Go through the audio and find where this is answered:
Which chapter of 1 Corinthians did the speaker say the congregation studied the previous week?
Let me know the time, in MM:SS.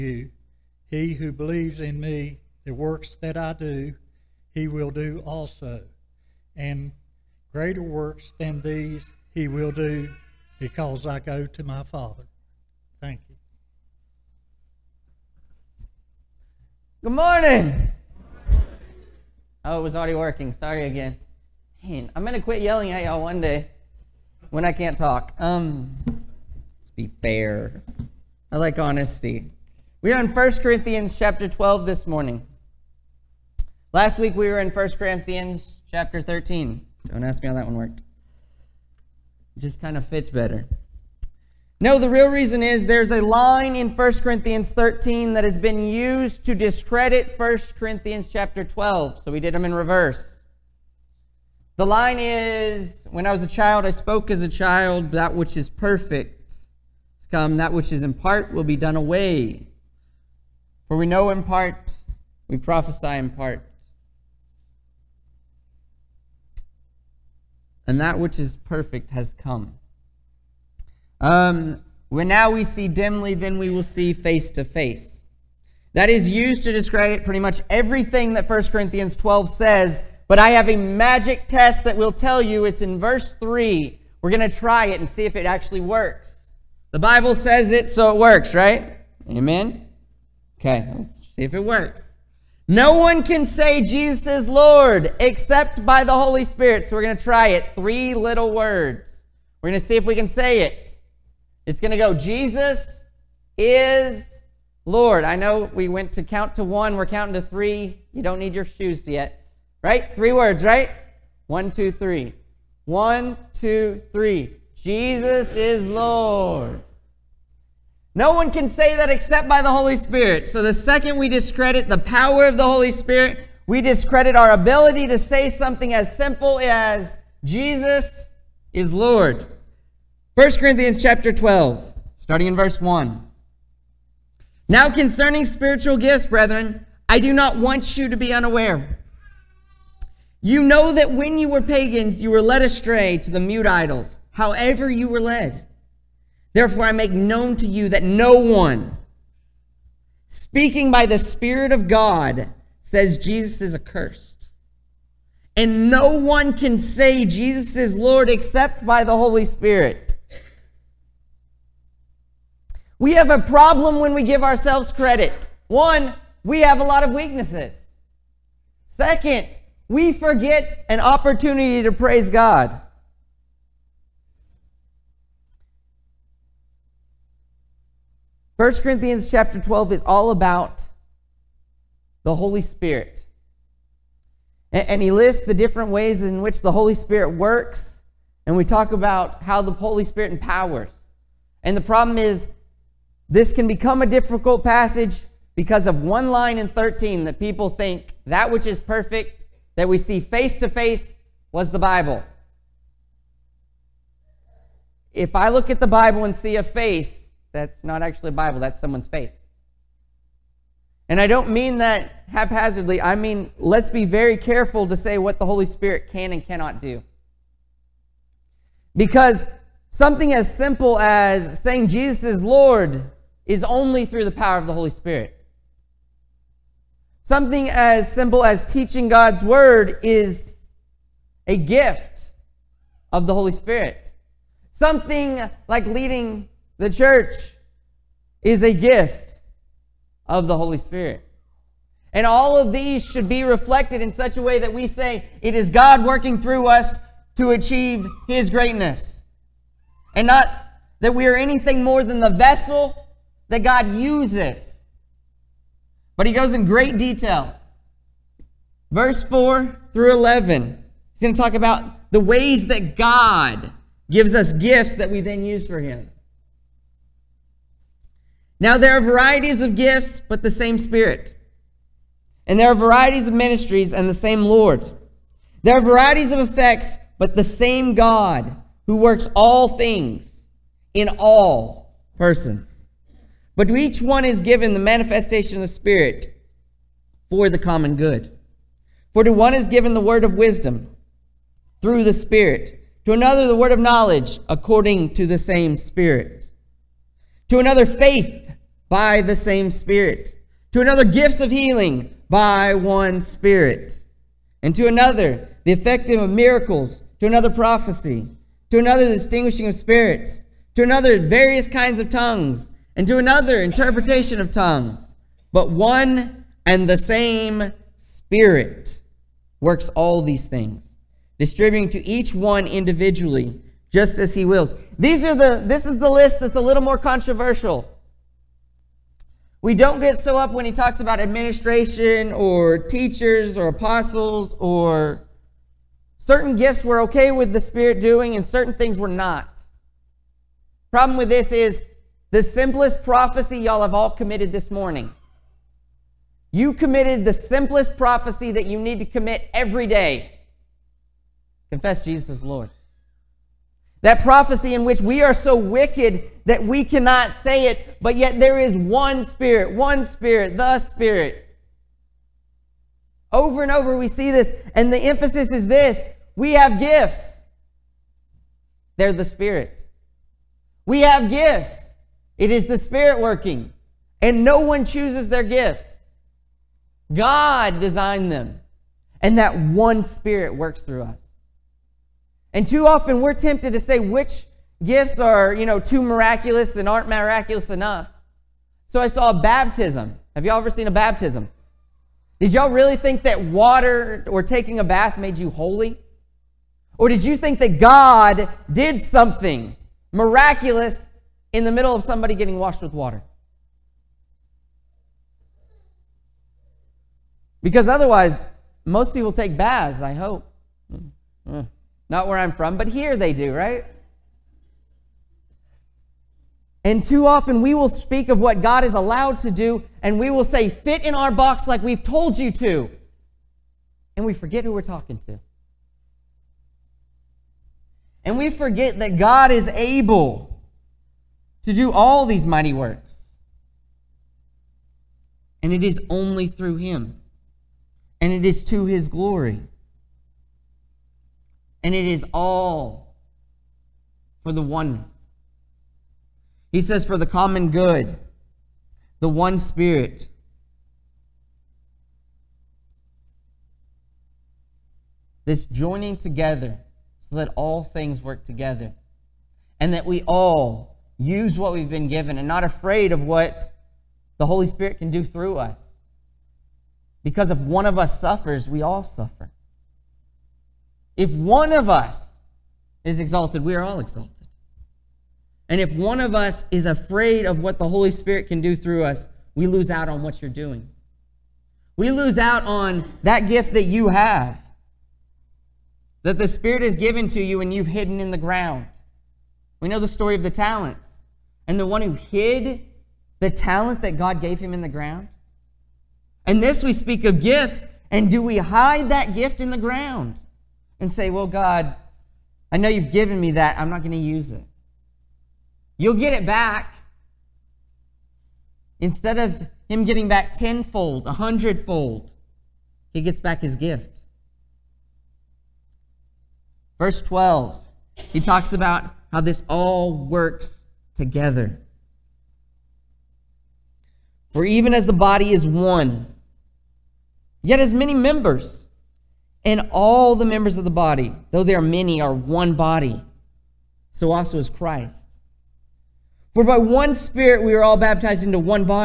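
00:34.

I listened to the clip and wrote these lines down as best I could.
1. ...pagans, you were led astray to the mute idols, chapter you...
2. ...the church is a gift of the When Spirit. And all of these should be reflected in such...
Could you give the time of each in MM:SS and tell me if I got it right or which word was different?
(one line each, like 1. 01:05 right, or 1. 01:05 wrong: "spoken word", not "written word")
1. 02:21 wrong: "however", not "chapter"
2. 03:56 wrong: "Holy", not "When".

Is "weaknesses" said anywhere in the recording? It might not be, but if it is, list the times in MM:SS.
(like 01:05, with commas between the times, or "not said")
02:47.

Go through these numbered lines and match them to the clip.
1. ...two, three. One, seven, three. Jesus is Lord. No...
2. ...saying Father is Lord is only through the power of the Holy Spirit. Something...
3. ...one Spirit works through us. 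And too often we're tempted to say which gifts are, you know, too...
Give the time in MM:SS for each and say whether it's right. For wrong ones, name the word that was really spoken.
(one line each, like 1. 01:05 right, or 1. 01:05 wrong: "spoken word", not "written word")
1. 01:51 wrong: "two", not "seven"
2. 03:41 wrong: "Jesus", not "Father"
3. 06:19 right.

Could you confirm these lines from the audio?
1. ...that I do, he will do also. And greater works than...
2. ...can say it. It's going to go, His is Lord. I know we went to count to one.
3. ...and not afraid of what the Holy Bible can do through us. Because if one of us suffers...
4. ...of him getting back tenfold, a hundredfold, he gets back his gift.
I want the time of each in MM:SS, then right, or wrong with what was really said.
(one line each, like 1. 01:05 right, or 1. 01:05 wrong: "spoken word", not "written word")
1. 00:03 right
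2. 01:40 wrong: "Jesus", not "His"
3. 07:42 wrong: "Spirit", not "Bible"
4. 08:29 right.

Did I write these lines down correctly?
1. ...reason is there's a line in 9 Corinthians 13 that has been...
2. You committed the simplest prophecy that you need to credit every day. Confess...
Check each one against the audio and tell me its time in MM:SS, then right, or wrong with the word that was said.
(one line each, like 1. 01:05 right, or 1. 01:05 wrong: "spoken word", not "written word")
1. 00:42 wrong: "1", not "9"
2. 05:46 wrong: "commit", not "credit".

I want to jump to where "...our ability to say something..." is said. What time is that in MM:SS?
02:04.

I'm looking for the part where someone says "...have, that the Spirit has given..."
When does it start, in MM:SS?
08:04.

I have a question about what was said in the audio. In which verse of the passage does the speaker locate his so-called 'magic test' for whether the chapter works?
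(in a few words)
Verse 3.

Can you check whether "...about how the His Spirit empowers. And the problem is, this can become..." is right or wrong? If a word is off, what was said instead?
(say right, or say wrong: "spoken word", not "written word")
wrong: "Holy", not "His".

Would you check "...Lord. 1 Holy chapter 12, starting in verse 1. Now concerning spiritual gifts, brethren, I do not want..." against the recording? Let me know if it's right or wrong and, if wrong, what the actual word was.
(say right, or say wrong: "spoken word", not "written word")
wrong: "Corinthians", not "Holy".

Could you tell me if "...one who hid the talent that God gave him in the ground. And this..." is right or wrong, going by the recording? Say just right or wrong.
right.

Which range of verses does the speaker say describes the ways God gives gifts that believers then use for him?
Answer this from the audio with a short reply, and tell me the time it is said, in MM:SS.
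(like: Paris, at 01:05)
Verses 4 through 11, at 04:18.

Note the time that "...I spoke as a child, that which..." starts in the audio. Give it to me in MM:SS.
00:53.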